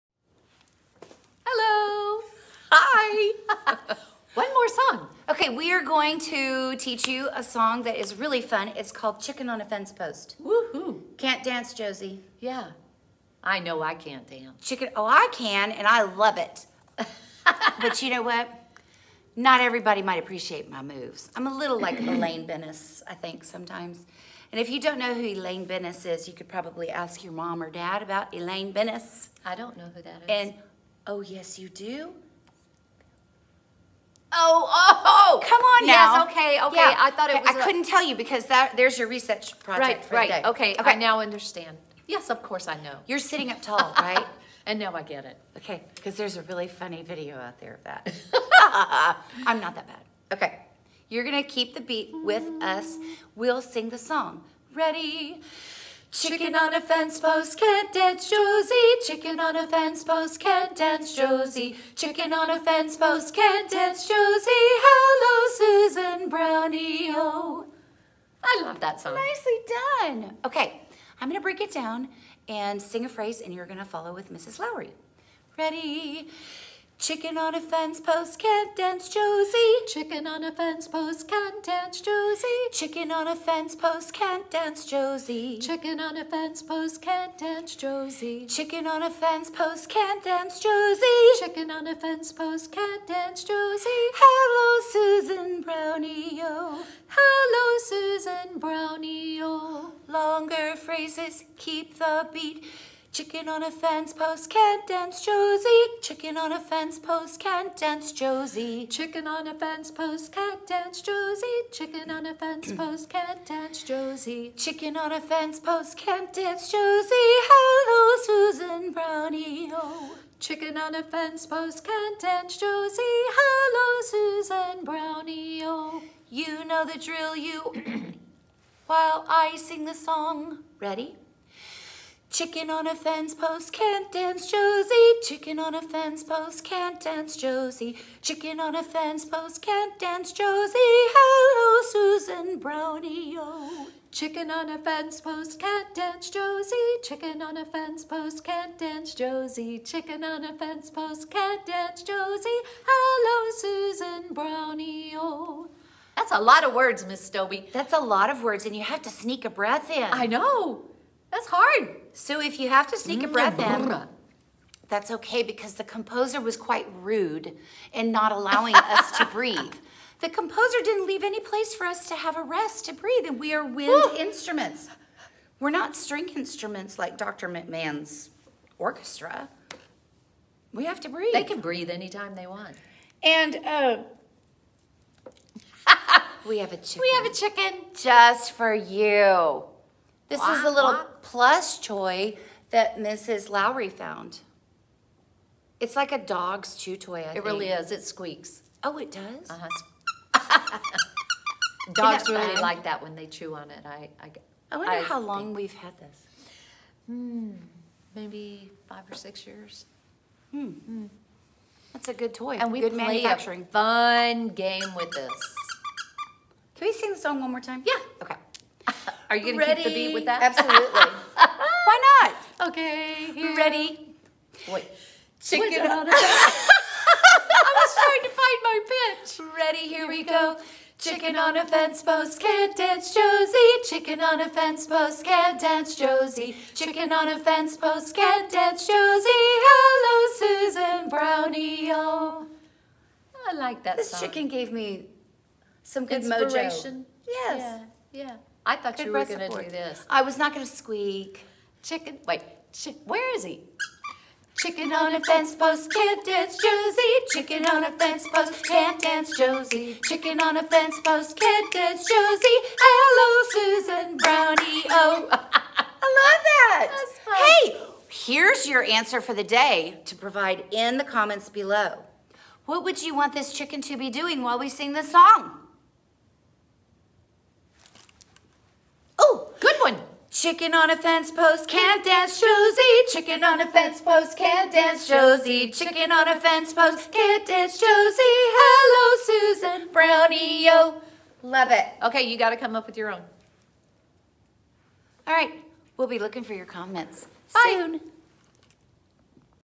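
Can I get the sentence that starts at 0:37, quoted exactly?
couldn't tell you because that there's your research project.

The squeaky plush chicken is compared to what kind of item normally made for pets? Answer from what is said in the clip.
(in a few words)
dog's chew toy.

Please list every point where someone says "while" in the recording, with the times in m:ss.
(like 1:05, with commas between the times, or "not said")
2:08, 4:34.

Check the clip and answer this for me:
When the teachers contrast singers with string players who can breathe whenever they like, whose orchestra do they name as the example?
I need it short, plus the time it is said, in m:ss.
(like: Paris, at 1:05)
Dr. McMahon's, at 2:57.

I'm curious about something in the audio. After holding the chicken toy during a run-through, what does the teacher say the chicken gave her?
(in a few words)
good mojo.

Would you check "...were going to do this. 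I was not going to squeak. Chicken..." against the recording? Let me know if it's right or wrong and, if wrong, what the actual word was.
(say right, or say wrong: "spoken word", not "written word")
right.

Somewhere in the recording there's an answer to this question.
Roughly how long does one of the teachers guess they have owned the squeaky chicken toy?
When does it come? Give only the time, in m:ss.
3:28.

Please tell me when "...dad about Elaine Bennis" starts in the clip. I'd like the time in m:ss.
0:27.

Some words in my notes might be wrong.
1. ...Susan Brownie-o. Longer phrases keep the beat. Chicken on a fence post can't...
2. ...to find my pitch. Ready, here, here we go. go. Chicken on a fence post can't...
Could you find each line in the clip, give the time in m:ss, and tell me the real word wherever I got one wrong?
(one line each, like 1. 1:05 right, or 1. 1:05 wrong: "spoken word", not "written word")
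1. 1:37 right
2. 3:48 right.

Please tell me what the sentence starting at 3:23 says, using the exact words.
I, I, I wonder I how long think.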